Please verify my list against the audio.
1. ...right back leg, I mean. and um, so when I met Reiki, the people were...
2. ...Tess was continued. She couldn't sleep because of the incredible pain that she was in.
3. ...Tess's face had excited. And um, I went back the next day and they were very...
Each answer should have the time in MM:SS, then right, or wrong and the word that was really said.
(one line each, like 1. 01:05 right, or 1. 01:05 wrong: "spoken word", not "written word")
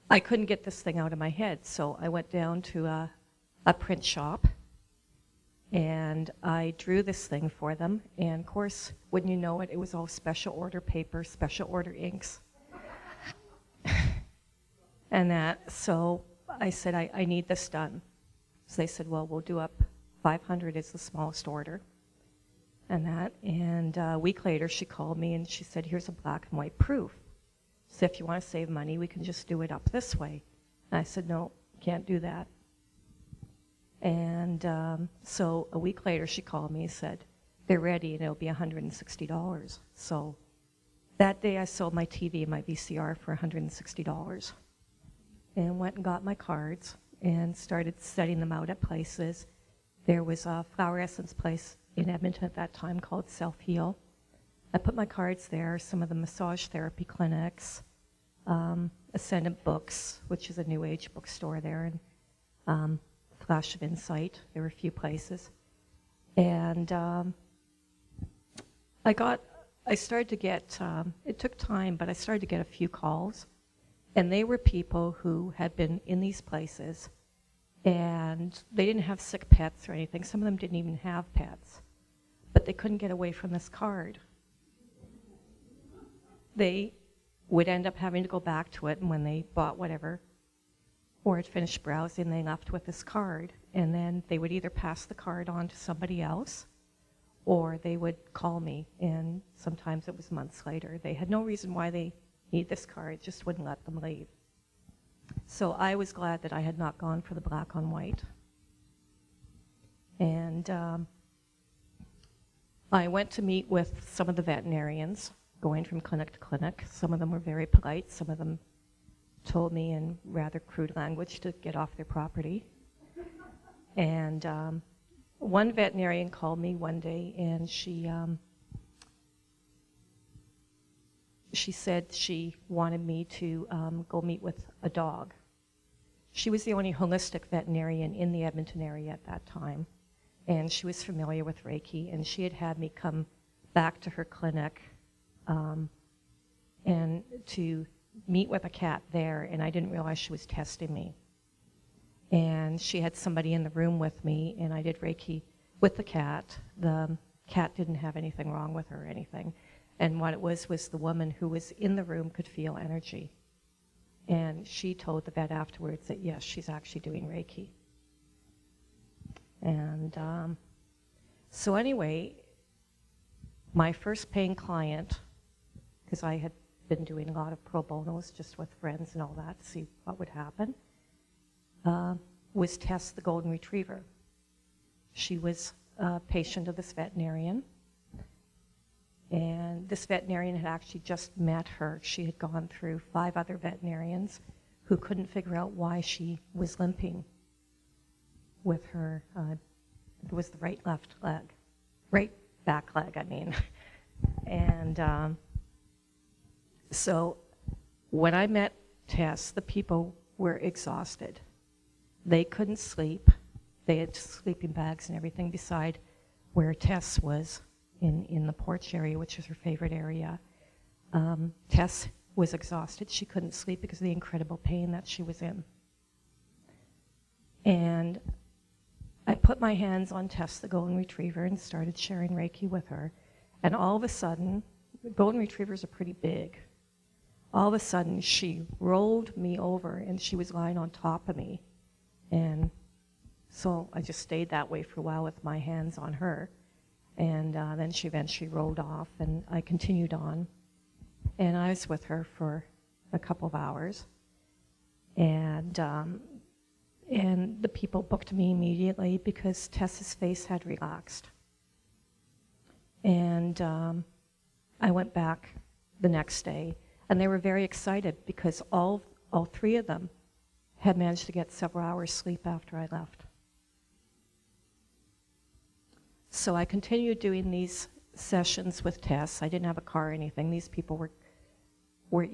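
1. 03:22 wrong: "Tess", not "Reiki"
2. 03:41 wrong: "exhausted", not "continued"
3. 04:19 wrong: "relaxed", not "excited".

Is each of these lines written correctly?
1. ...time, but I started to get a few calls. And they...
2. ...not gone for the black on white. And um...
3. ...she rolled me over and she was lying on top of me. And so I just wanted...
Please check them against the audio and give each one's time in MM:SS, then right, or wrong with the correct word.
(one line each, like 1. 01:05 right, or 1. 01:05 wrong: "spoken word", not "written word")
1. 01:11 right
2. 01:46 right
3. 03:58 wrong: "stayed", not "wanted".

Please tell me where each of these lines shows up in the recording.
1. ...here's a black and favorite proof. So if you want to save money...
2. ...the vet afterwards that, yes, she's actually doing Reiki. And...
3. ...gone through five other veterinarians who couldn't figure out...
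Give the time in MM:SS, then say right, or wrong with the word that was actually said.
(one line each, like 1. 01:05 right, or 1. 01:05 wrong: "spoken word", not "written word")
1. 00:25 wrong: "white", not "favorite"
2. 02:45 right
3. 03:12 right.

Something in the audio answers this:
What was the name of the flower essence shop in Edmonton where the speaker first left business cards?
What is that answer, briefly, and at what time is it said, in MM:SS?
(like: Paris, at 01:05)
Self Heal, at 00:53.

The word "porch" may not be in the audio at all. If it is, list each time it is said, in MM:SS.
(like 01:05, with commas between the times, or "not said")
03:38.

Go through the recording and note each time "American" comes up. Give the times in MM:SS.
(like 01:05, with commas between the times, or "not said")
not said.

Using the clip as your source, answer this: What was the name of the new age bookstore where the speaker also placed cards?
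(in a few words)
Ascendant Books.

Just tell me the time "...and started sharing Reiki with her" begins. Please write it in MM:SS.
03:51.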